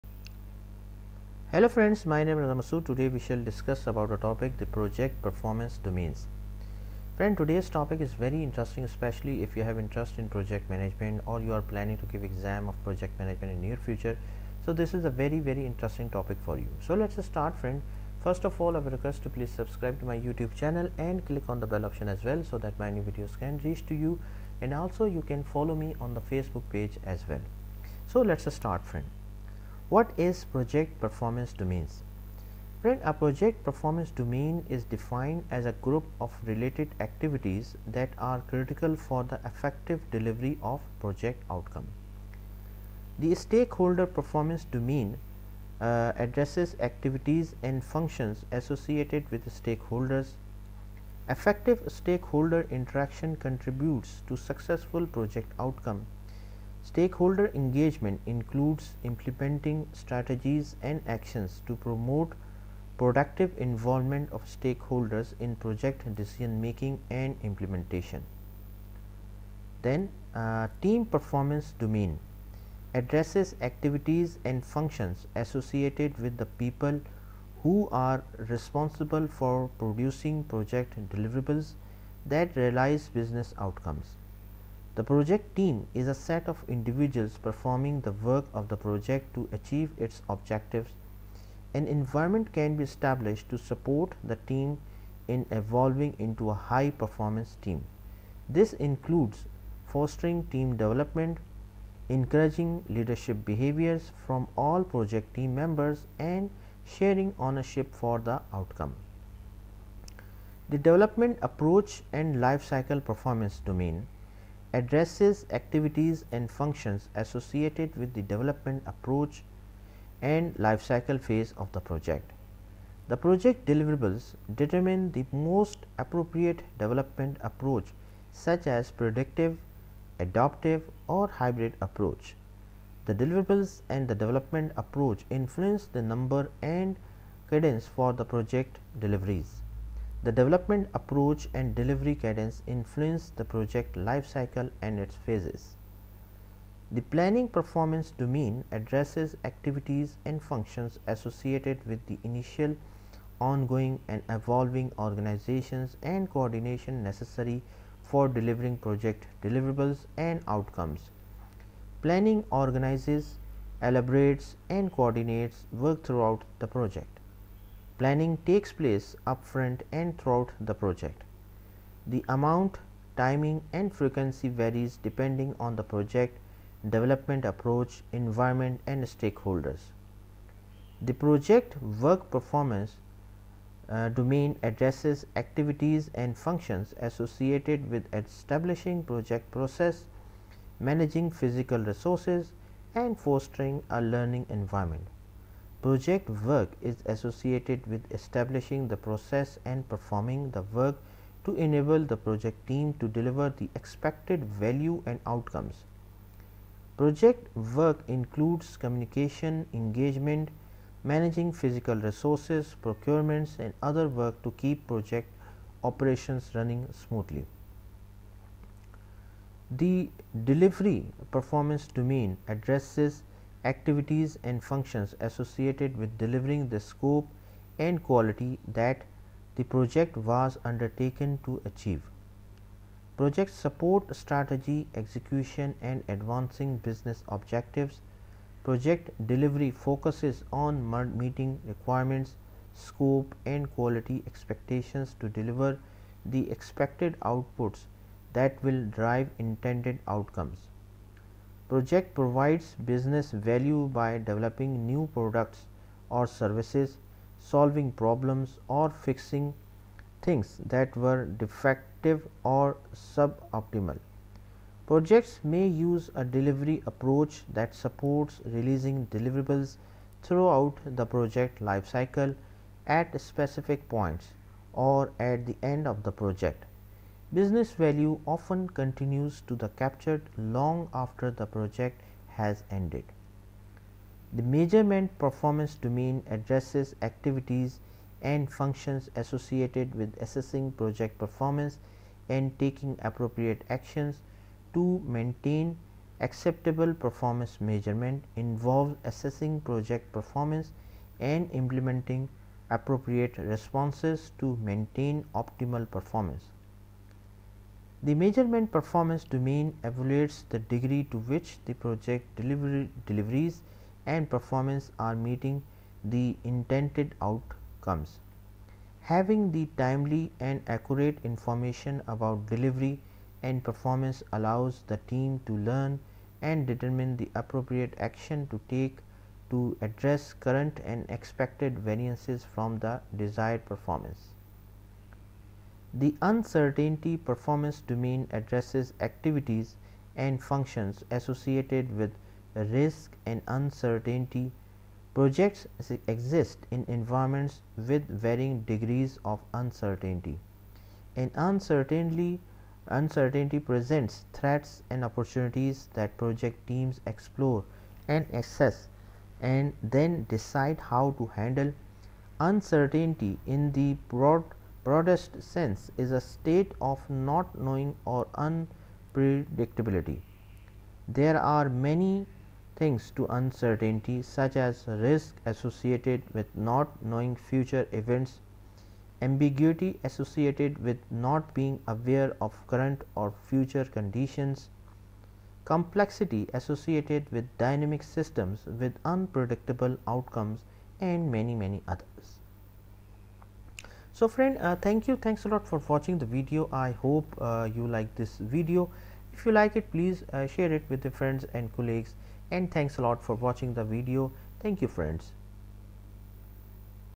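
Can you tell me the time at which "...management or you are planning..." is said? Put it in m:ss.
0:10.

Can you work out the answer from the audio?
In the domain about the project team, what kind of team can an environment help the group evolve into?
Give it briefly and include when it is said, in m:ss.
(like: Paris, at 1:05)
High performance team, at 1:36.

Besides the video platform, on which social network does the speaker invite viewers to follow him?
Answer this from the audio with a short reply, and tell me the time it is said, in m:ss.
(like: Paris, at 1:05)
Facebook, at 0:26.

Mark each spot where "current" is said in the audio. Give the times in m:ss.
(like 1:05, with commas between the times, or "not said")
5:30, 6:22.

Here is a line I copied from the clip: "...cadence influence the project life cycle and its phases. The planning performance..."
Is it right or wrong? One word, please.
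right.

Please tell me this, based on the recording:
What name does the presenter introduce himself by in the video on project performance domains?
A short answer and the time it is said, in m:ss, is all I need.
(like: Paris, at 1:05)
Ramasu, at 0:02.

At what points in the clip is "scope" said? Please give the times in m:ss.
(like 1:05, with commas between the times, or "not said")
3:46, 4:02.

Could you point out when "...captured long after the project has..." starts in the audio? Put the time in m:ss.
4:39.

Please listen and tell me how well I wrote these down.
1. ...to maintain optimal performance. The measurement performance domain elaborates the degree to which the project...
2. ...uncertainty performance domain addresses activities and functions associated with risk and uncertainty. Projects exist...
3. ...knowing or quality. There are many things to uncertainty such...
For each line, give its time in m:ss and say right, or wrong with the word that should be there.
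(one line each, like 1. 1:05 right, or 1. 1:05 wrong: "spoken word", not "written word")
1. 5:04 wrong: "evaluates", not "elaborates"
2. 5:36 right
3. 6:07 wrong: "unpredictability", not "quality".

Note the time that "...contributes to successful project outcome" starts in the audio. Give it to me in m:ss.
0:53.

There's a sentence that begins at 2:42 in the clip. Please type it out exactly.
Planning organizes, elaborates and coordinates work throughout the project.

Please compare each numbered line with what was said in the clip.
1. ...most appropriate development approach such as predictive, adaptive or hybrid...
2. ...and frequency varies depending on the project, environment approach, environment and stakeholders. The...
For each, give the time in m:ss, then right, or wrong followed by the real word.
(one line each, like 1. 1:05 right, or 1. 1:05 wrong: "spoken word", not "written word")
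1. 2:05 right
2. 2:53 wrong: "development", not "environment".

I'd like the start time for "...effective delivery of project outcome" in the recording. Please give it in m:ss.
0:39.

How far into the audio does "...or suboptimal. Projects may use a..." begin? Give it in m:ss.
4:22.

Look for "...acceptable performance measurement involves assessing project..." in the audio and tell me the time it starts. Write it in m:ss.
4:56.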